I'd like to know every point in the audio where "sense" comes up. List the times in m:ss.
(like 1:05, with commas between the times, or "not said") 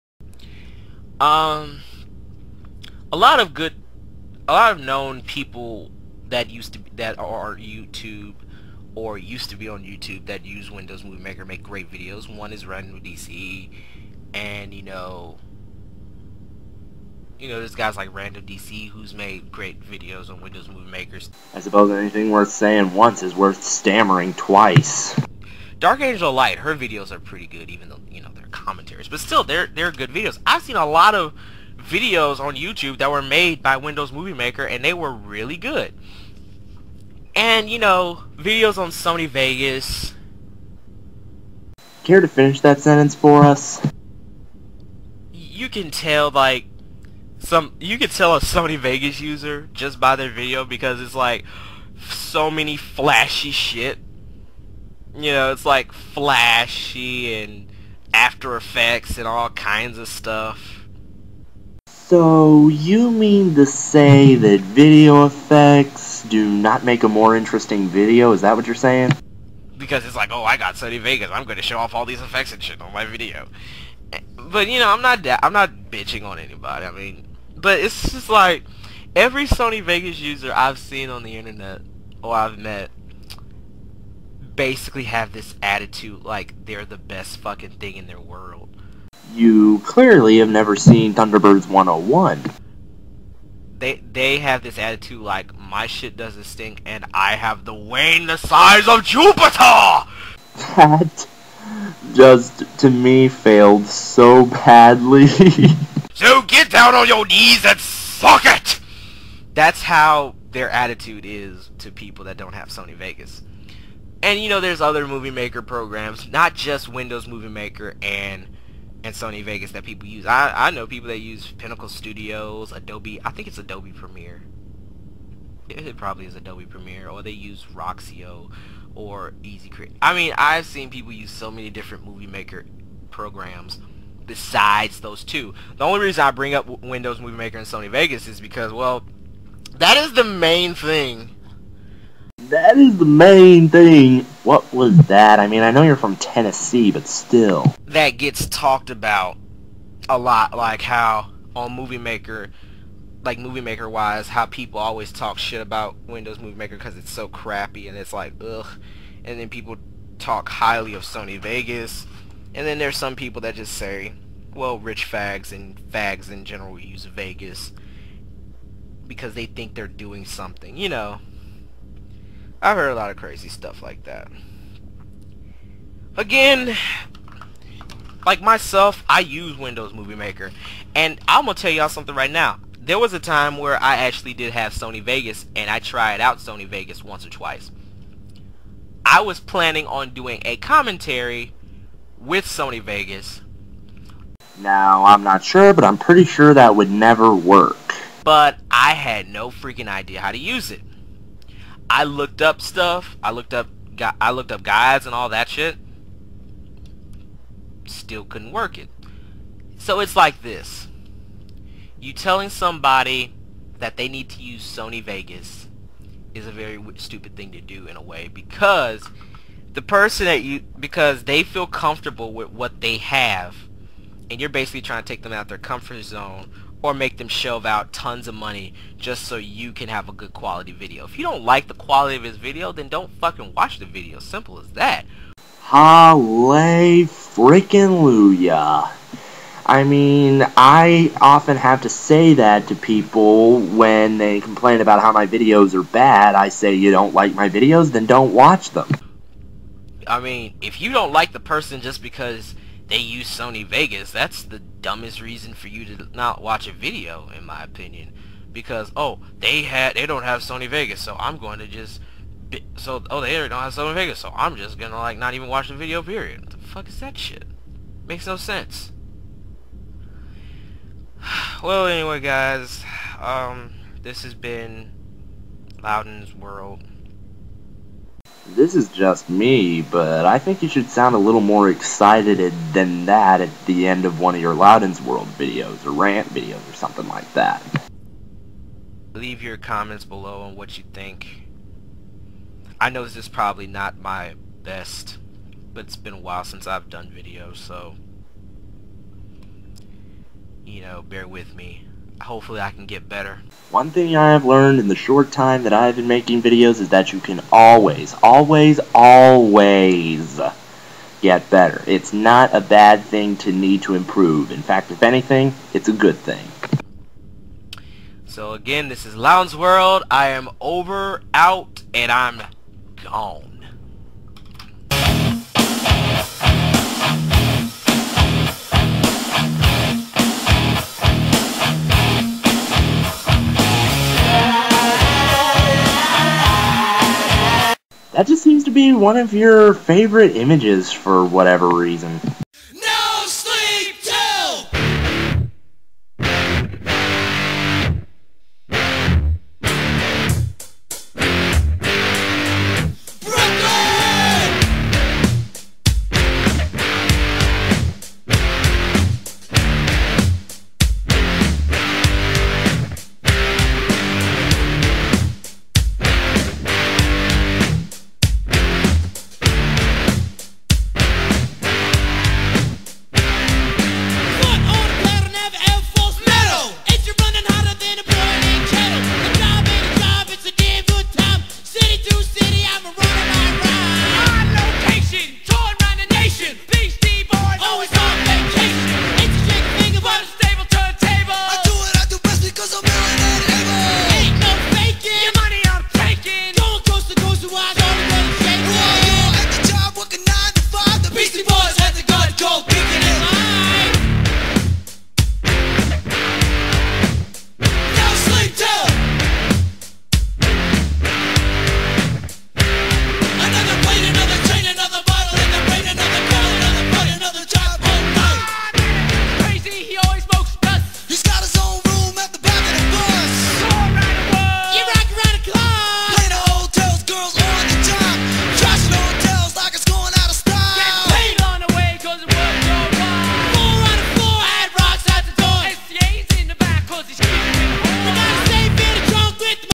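4:28.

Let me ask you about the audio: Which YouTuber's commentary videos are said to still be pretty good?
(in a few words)
Dark Angel Light.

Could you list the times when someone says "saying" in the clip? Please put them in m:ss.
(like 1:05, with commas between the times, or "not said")
0:22, 1:08.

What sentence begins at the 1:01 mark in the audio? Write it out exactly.
So, you mean to say that video effects do not make a more interesting video?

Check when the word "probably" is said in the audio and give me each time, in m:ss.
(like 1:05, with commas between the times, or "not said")
2:05, 4:53.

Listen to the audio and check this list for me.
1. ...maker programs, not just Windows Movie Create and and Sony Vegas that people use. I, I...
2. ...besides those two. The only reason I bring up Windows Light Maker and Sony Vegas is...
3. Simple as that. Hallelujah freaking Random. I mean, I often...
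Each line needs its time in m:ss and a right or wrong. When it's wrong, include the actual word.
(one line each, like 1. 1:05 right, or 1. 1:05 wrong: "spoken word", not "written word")
1. 1:55 wrong: "Maker", not "Create"
2. 2:14 wrong: "Movie", not "Light"
3. 3:54 wrong: "Luya", not "Random".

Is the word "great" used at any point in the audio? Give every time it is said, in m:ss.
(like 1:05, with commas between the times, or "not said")
0:11, 0:19.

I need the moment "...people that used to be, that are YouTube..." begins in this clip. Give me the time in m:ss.
0:05.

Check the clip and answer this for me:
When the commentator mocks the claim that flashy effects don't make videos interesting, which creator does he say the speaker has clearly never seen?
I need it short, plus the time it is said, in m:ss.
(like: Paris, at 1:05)
Thunderbirds 101, at 1:31.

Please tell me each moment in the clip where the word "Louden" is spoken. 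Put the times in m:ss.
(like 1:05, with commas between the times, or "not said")
4:35, 4:44, 5:19.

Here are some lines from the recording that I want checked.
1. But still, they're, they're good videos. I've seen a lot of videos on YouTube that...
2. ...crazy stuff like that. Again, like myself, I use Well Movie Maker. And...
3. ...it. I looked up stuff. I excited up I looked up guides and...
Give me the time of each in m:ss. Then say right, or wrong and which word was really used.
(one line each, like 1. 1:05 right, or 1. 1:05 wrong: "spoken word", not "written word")
1. 0:29 right
2. 2:53 wrong: "Windows", not "Well"
3. 3:20 wrong: "looked", not "excited".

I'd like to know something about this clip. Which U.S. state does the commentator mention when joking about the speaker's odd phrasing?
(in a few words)
Tennessee.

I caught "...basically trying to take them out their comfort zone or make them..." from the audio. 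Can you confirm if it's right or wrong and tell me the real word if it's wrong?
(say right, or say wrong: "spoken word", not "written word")
right.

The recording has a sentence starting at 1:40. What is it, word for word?
That just to me failed so badly.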